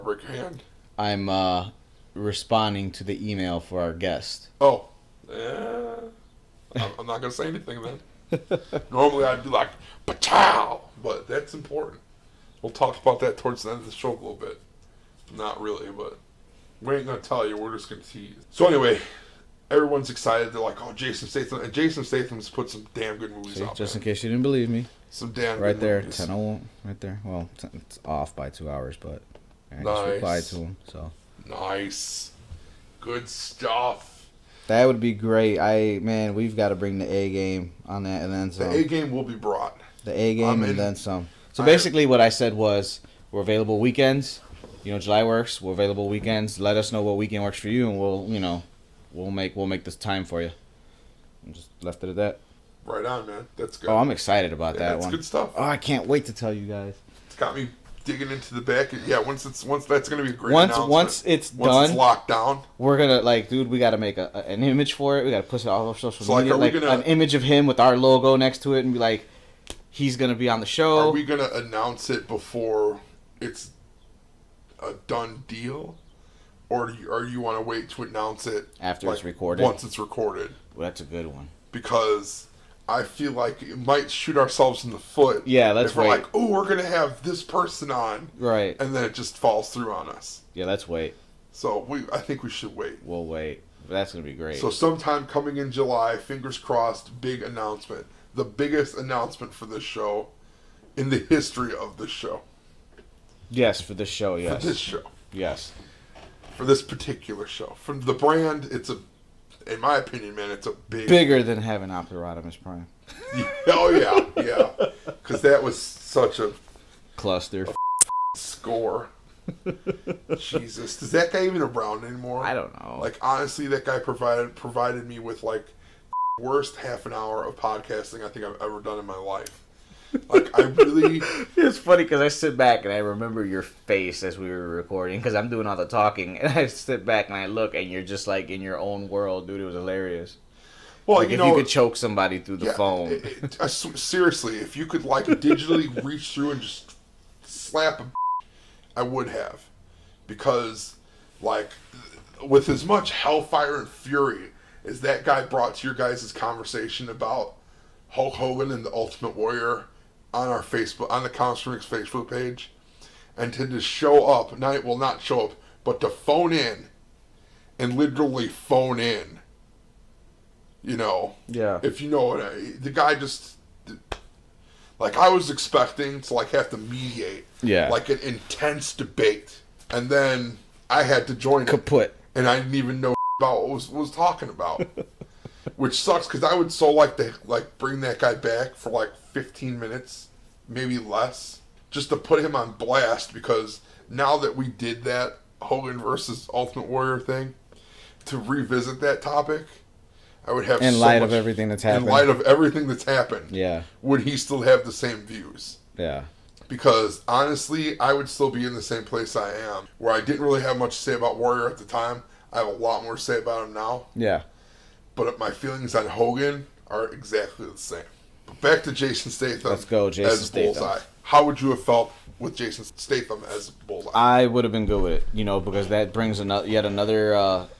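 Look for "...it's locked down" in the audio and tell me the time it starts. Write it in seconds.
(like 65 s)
61 s.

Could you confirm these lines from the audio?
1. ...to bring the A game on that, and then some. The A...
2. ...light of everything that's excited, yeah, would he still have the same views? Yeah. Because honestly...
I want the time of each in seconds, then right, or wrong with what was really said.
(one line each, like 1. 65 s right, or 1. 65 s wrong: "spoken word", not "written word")
1. 36 s right
2. 202 s wrong: "happened", not "excited".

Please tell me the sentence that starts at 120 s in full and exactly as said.
Jesus, does that guy even around anymore?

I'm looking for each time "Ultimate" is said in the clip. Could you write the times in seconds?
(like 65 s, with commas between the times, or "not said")
158 s, 196 s.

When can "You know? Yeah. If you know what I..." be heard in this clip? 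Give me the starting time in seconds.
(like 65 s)
170 s.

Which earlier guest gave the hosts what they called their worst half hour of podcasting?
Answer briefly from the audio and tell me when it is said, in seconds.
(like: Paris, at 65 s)
Optimus Prime, at 111 s.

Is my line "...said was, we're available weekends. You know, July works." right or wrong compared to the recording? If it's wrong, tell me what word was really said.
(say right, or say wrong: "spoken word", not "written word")
right.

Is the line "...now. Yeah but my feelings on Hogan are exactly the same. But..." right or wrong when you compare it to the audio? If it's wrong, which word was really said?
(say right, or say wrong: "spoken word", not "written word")
right.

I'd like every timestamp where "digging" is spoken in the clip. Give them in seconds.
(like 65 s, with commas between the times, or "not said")
58 s.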